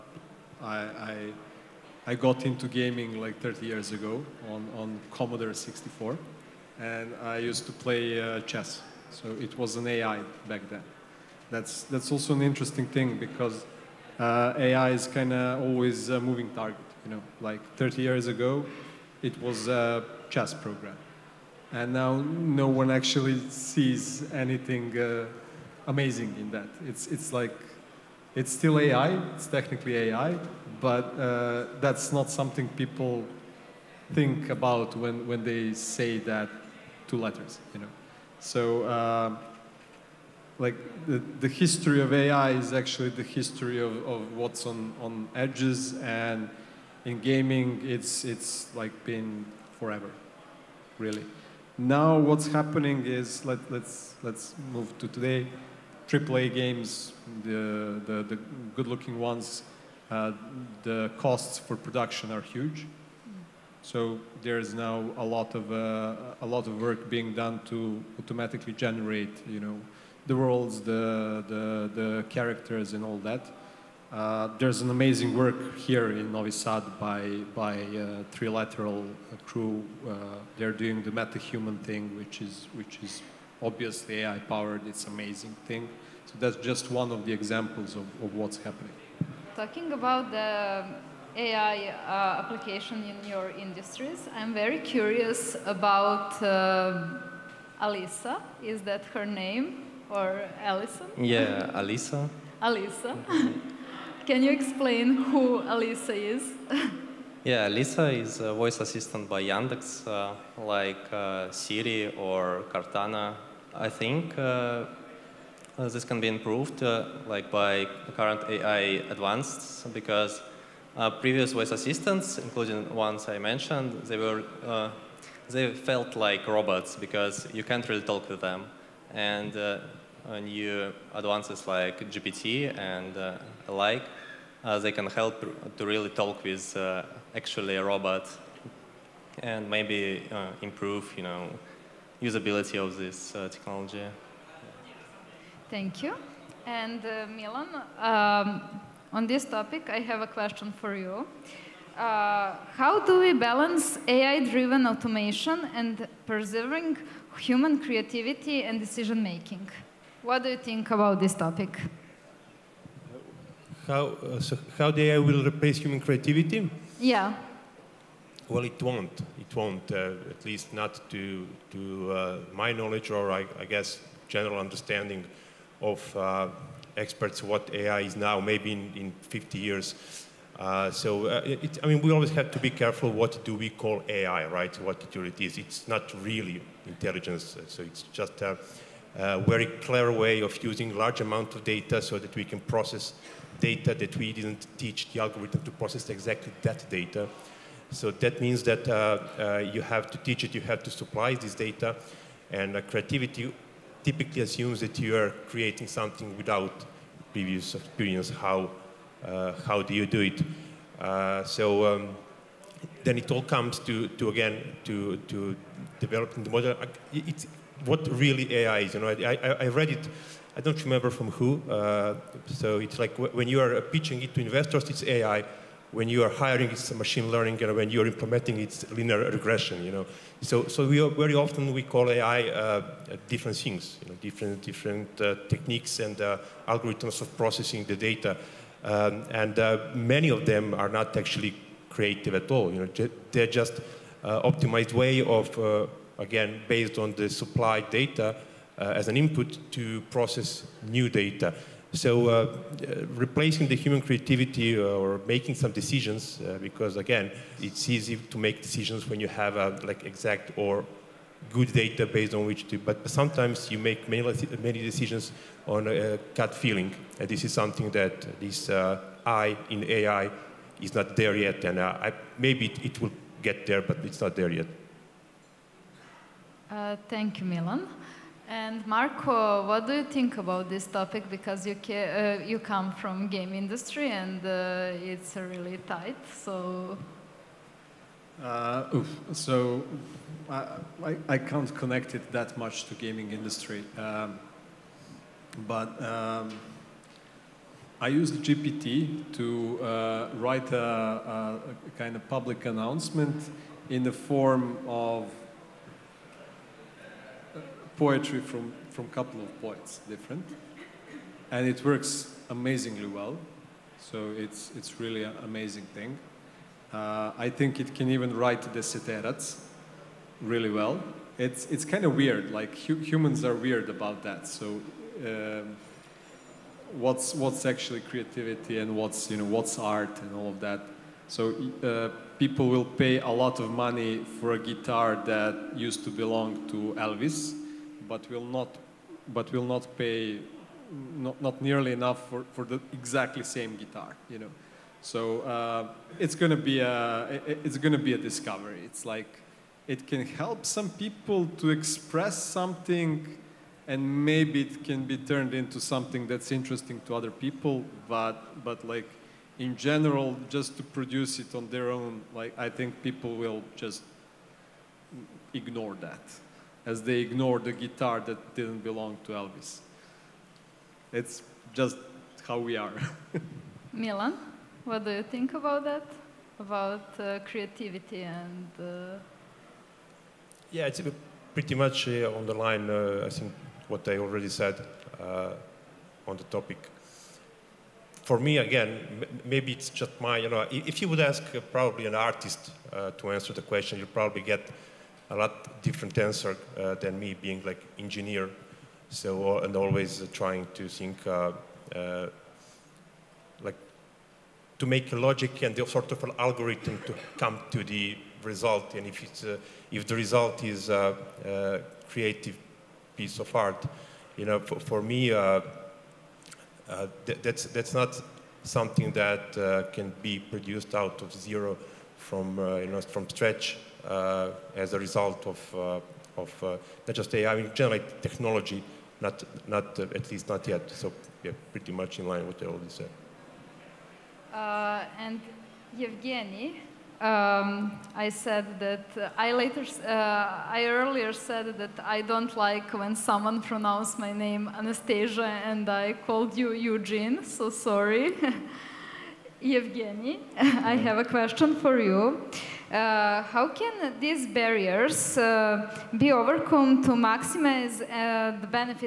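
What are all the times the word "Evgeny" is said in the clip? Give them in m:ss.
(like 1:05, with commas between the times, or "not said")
7:15, 7:29.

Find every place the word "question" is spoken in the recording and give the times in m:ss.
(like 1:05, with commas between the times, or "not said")
2:30, 6:33, 7:31.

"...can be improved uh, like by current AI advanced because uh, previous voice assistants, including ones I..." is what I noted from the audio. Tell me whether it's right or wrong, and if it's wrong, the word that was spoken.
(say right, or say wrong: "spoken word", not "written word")
right.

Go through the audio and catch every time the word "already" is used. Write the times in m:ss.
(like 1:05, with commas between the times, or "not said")
6:24, 7:12.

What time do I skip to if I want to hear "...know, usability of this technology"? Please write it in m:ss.
2:21.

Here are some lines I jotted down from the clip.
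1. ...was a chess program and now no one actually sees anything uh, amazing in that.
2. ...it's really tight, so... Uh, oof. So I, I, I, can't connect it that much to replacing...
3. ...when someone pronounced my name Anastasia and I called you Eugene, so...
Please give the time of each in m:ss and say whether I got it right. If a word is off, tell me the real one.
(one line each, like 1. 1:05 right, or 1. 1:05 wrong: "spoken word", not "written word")
1. 0:19 right
2. 4:45 wrong: "gaming", not "replacing"
3. 7:22 right.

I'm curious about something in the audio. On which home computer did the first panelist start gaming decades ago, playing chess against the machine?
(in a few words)
Commodore 64.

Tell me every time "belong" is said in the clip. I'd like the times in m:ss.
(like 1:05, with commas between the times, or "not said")
5:36, 6:08.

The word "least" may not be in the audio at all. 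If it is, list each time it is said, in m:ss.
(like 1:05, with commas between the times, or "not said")
2:50, 7:10.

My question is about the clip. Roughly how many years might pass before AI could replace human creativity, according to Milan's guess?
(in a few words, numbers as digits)
50.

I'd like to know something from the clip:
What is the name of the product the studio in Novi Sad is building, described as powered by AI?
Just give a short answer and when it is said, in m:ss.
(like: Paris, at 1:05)
MetaHuman, at 1:21.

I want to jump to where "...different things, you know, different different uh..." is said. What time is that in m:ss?
3:53.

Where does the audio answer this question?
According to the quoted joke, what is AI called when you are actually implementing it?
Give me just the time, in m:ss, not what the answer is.
3:48.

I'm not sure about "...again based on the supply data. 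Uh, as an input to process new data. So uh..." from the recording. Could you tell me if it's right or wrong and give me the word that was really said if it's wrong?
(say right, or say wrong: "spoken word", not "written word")
right.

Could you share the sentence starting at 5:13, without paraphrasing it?
So it's it's really an amazing thing.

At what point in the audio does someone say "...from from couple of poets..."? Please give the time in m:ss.
5:08.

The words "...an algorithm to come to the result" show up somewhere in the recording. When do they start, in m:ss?
6:46.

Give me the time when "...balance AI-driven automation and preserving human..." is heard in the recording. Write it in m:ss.
2:33.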